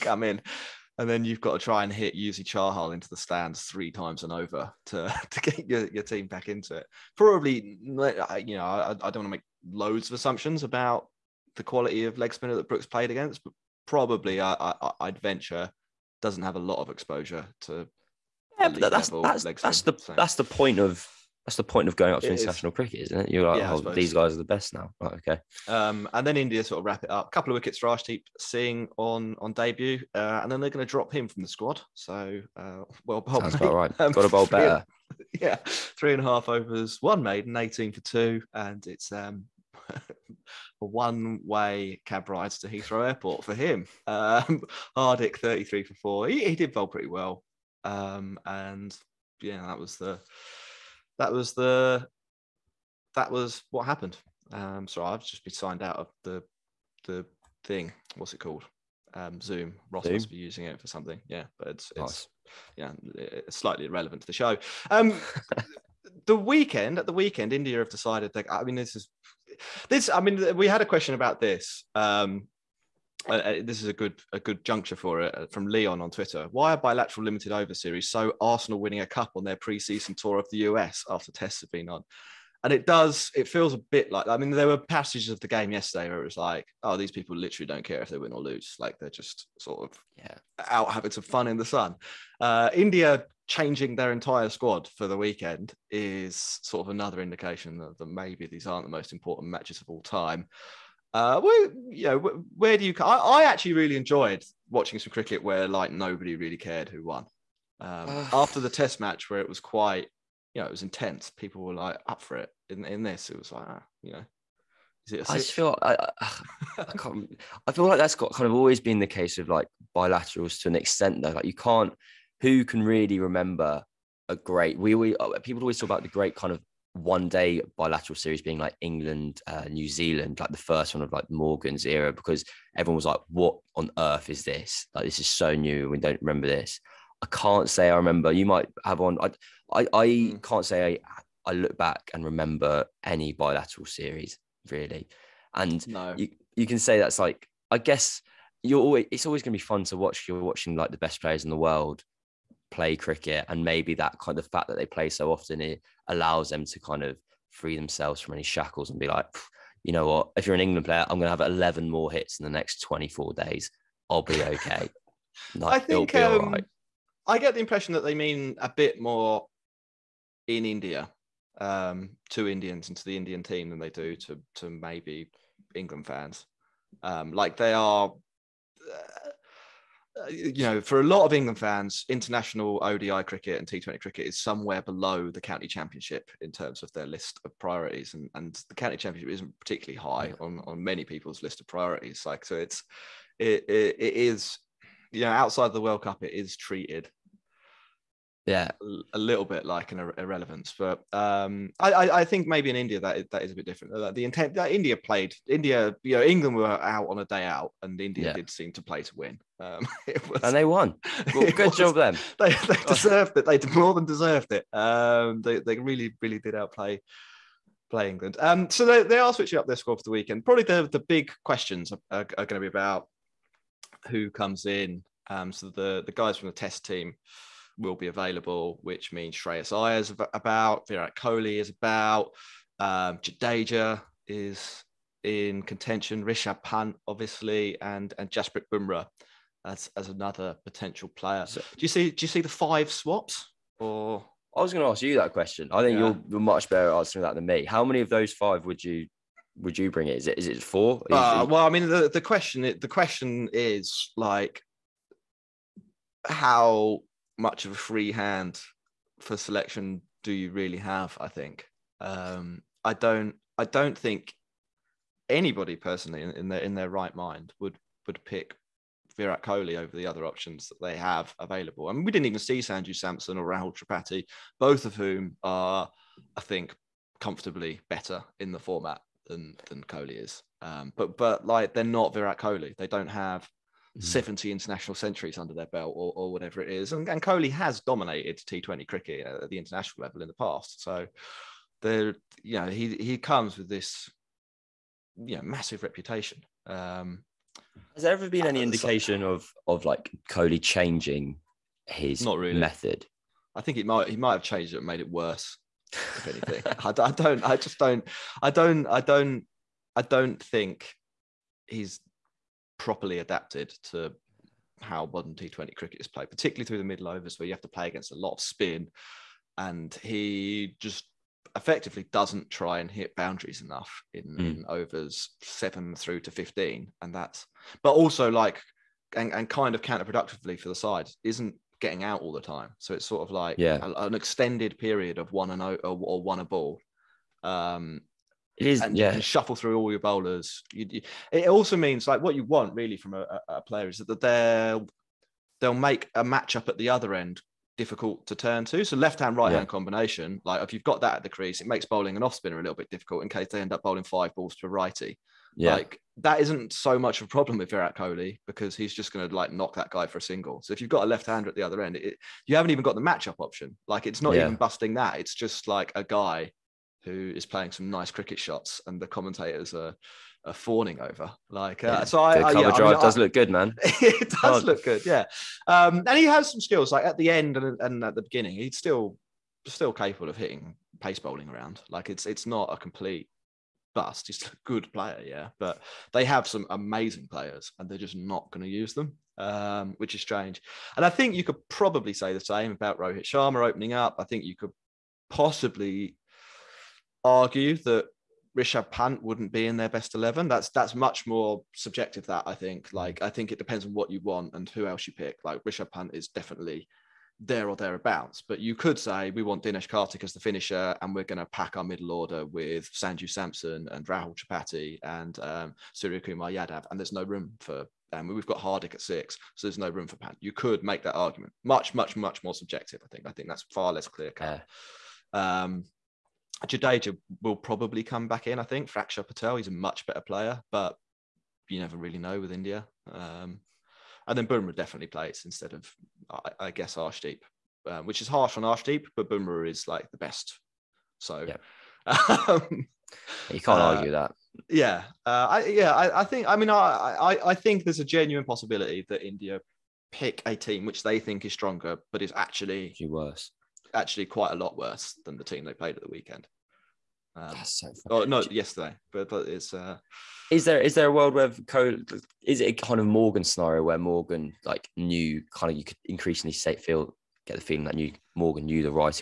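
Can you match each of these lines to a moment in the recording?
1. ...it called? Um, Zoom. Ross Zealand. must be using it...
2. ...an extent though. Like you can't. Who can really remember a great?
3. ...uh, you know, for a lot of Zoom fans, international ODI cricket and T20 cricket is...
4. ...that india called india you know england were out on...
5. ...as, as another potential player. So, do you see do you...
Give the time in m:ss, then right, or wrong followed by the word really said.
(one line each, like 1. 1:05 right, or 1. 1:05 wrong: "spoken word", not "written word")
1. 0:58 wrong: "Zoom", not "Zealand"
2. 2:00 right
3. 3:00 wrong: "England", not "Zoom"
4. 3:24 wrong: "played", not "called"
5. 3:59 right.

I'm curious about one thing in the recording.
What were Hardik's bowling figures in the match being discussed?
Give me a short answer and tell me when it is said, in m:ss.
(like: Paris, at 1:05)
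33 for 4, at 0:45.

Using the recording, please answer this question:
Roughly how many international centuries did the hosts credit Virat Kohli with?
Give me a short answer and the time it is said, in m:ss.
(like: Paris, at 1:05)
70, at 4:44.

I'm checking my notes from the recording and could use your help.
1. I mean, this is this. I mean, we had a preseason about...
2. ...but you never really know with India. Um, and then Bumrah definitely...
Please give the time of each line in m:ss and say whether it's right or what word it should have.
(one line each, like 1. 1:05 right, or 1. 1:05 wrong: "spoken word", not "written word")
1. 1:08 wrong: "question", not "preseason"
2. 7:10 right.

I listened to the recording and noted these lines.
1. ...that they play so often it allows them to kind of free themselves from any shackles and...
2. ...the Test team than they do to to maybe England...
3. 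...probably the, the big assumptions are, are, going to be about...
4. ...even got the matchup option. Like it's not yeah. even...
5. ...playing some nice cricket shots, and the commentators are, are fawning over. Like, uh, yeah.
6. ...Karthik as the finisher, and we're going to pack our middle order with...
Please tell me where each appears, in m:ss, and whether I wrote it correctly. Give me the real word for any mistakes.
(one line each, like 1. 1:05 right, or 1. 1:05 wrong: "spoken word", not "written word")
1. 2:34 right
2. 2:53 wrong: "Indian", not "Test"
3. 3:40 wrong: "questions", not "assumptions"
4. 6:02 right
5. 6:07 right
6. 6:49 right.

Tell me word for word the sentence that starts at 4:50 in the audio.
So there, you know, he, he comes with this, you know, massive reputation.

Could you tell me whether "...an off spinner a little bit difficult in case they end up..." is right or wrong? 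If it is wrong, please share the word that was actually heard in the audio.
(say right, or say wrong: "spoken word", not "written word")
right.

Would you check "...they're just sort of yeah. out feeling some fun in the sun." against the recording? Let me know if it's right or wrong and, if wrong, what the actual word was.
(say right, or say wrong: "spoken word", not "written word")
wrong: "having", not "feeling".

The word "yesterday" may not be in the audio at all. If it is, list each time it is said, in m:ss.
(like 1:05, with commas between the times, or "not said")
1:25, 7:38.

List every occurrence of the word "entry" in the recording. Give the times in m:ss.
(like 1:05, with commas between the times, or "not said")
not said.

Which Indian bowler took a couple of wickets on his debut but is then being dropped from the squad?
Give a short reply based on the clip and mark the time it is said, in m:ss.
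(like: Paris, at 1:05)
Arshdeep Singh, at 0:27.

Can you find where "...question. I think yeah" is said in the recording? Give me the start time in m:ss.
4:05.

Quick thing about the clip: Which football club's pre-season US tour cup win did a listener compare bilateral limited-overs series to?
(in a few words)
Arsenal.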